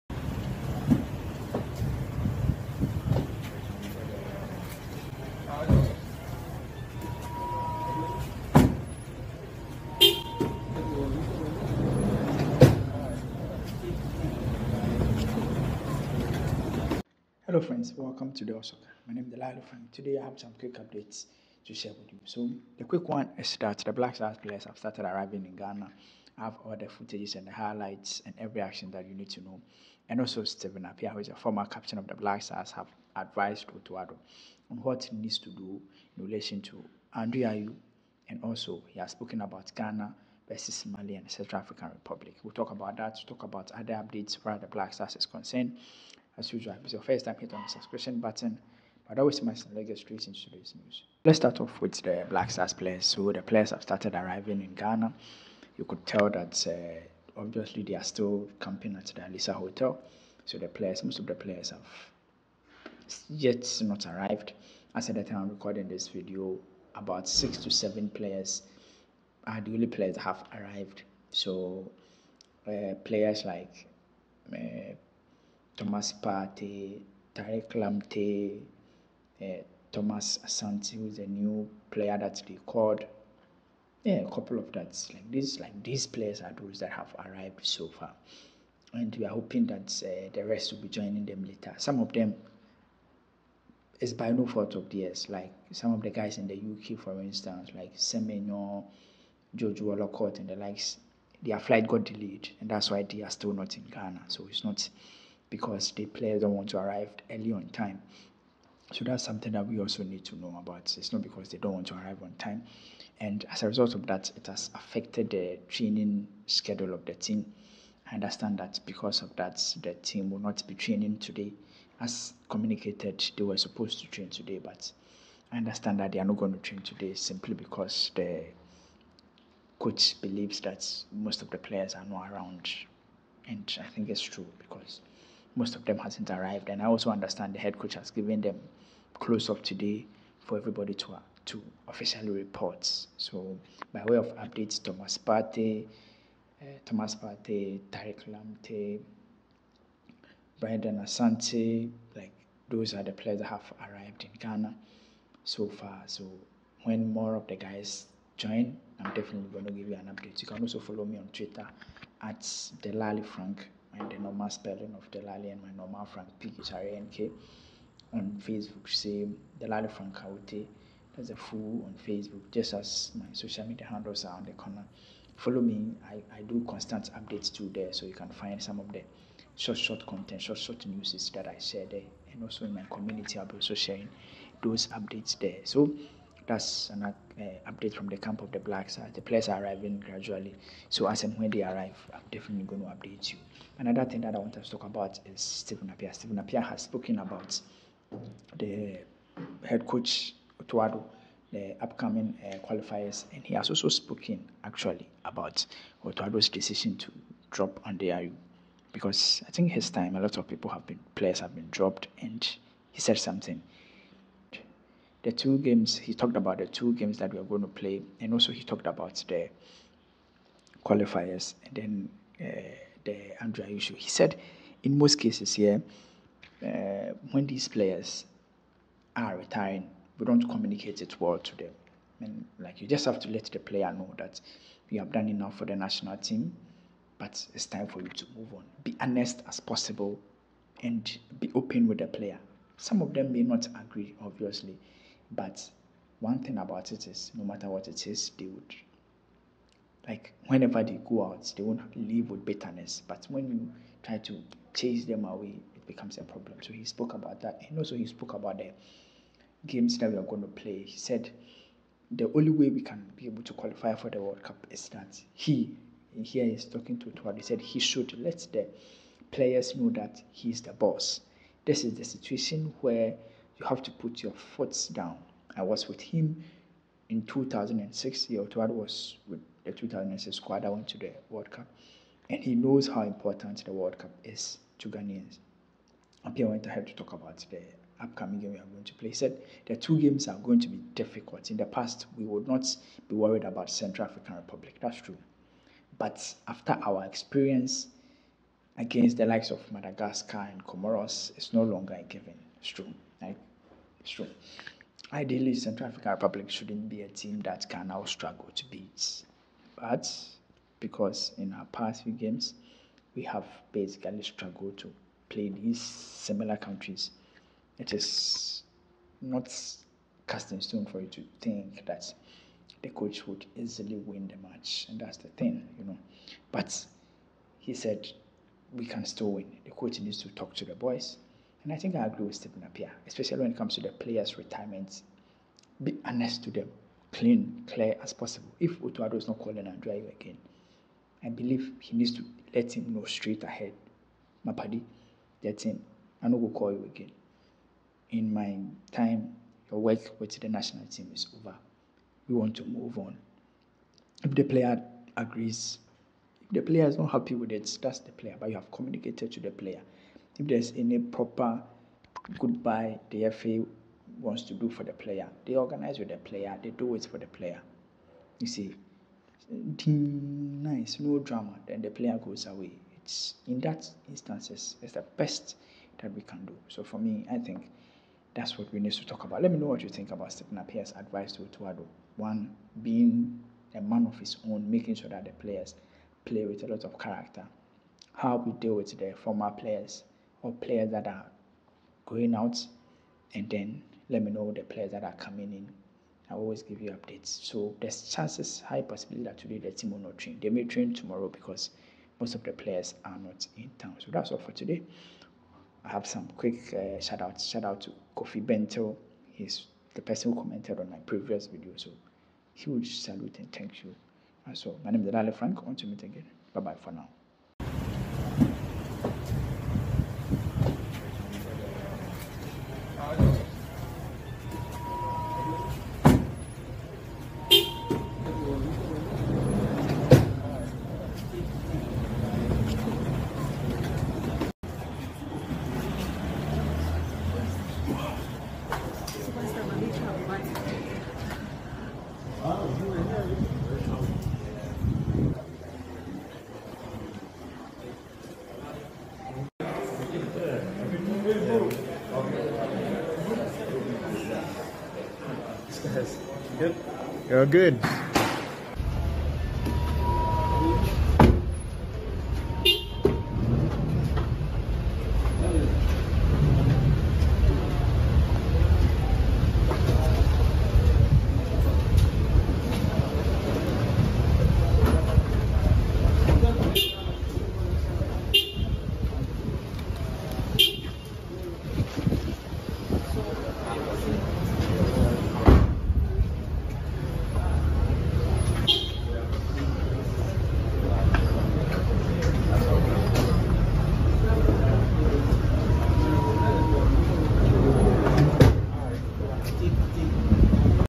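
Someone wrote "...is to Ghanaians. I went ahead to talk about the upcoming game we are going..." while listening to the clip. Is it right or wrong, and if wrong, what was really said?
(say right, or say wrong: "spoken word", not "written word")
right.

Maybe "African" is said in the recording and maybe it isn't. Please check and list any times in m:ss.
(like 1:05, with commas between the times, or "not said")
0:41, 4:54, 5:05.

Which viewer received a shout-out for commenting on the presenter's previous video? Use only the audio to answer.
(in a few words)
Kofi Bento.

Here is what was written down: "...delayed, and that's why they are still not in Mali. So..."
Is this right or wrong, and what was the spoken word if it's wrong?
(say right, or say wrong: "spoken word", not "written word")
wrong: "Ghana", not "Mali".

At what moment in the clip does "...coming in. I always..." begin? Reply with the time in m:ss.
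6:35.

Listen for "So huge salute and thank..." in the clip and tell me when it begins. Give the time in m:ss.
6:51.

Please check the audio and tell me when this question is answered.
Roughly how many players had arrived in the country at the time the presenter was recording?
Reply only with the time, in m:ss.
1:07.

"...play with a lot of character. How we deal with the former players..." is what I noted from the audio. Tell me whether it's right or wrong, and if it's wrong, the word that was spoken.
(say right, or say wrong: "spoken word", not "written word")
right.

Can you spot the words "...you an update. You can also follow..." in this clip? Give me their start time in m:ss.
2:39.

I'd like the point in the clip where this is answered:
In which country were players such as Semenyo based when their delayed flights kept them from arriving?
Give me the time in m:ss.
1:36.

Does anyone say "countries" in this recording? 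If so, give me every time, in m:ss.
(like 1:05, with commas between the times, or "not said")
5:16.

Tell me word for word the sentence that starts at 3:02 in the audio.
And also in my community, I'll be also sharing those updates there.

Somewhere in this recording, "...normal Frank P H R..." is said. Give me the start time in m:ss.
2:45.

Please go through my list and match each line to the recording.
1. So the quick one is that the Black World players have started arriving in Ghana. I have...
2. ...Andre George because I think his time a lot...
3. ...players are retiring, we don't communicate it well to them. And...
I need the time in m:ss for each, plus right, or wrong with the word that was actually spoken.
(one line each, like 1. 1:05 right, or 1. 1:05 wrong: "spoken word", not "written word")
1. 0:22 wrong: "Stars", not "World"
2. 3:27 wrong: "Ayew", not "George"
3. 3:47 right.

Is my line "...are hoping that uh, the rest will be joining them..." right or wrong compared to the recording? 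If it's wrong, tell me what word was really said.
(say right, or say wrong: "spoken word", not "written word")
right.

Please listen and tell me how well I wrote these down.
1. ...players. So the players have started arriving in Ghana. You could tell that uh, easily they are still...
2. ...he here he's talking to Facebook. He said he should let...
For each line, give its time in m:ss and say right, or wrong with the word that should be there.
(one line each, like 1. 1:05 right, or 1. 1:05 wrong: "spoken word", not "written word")
1. 0:52 wrong: "obviously", not "easily"
2. 4:25 wrong: "Tuad", not "Facebook".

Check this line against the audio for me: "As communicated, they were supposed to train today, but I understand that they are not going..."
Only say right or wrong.
right.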